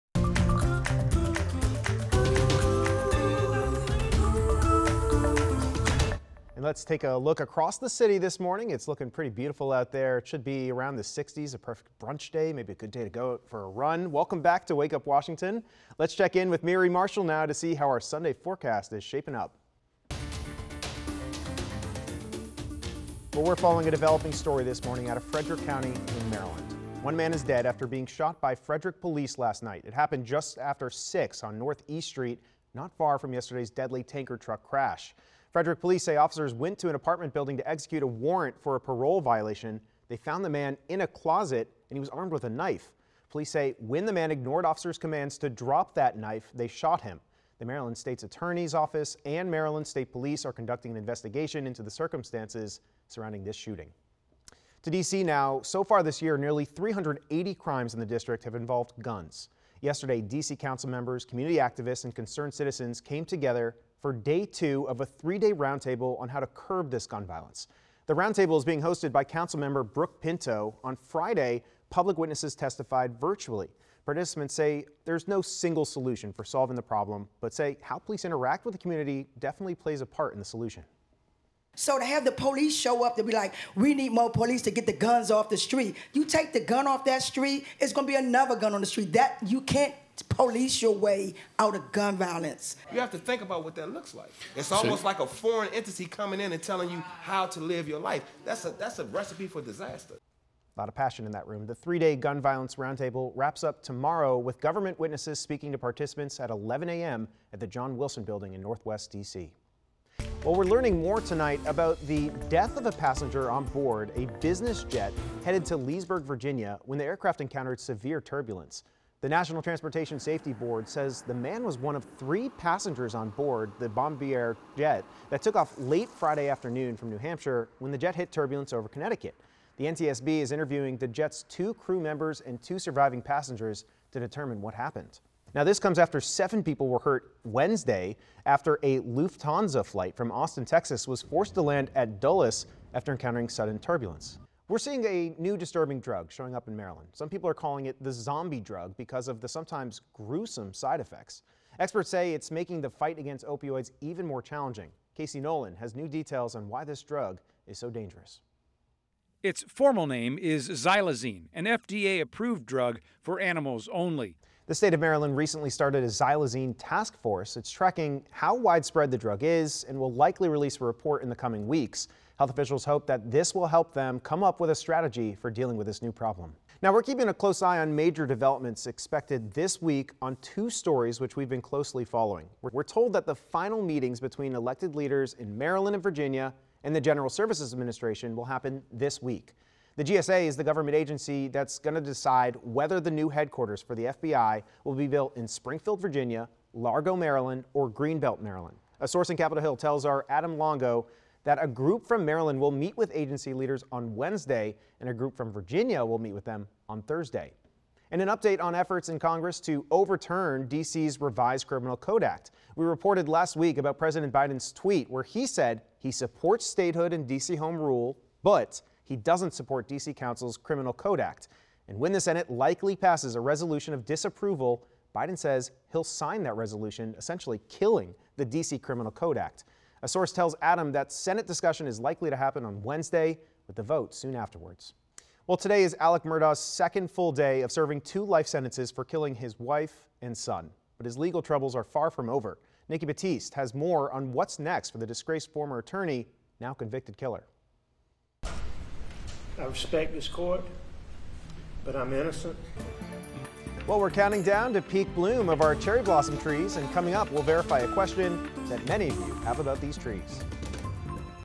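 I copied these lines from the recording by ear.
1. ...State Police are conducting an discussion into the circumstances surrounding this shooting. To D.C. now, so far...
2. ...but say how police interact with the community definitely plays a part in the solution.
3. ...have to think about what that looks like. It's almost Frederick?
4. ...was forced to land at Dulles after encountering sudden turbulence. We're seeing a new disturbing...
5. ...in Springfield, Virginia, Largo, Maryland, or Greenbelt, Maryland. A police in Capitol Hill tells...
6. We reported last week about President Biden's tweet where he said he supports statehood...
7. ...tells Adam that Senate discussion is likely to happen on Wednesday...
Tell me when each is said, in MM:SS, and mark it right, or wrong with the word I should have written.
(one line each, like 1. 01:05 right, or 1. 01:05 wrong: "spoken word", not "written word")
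1. 00:49 wrong: "investigation", not "discussion"
2. 01:17 right
3. 01:32 wrong: "See", not "Frederick"
4. 02:21 right
5. 03:15 wrong: "source", not "police"
6. 03:32 right
7. 03:50 right.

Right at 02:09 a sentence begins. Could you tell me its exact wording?
The NTSB is interviewing the jet's two crew members and two surviving passengers to determine what happened.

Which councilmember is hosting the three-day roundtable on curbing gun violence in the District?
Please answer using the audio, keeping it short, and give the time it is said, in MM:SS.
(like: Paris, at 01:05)
Brooke Pinto, at 01:09.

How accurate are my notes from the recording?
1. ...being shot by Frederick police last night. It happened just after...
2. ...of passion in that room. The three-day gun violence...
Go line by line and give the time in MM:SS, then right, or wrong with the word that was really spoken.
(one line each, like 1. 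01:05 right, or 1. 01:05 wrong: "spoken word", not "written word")
1. 00:27 right
2. 01:40 right.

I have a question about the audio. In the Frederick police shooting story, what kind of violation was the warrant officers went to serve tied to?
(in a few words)
Parole violation.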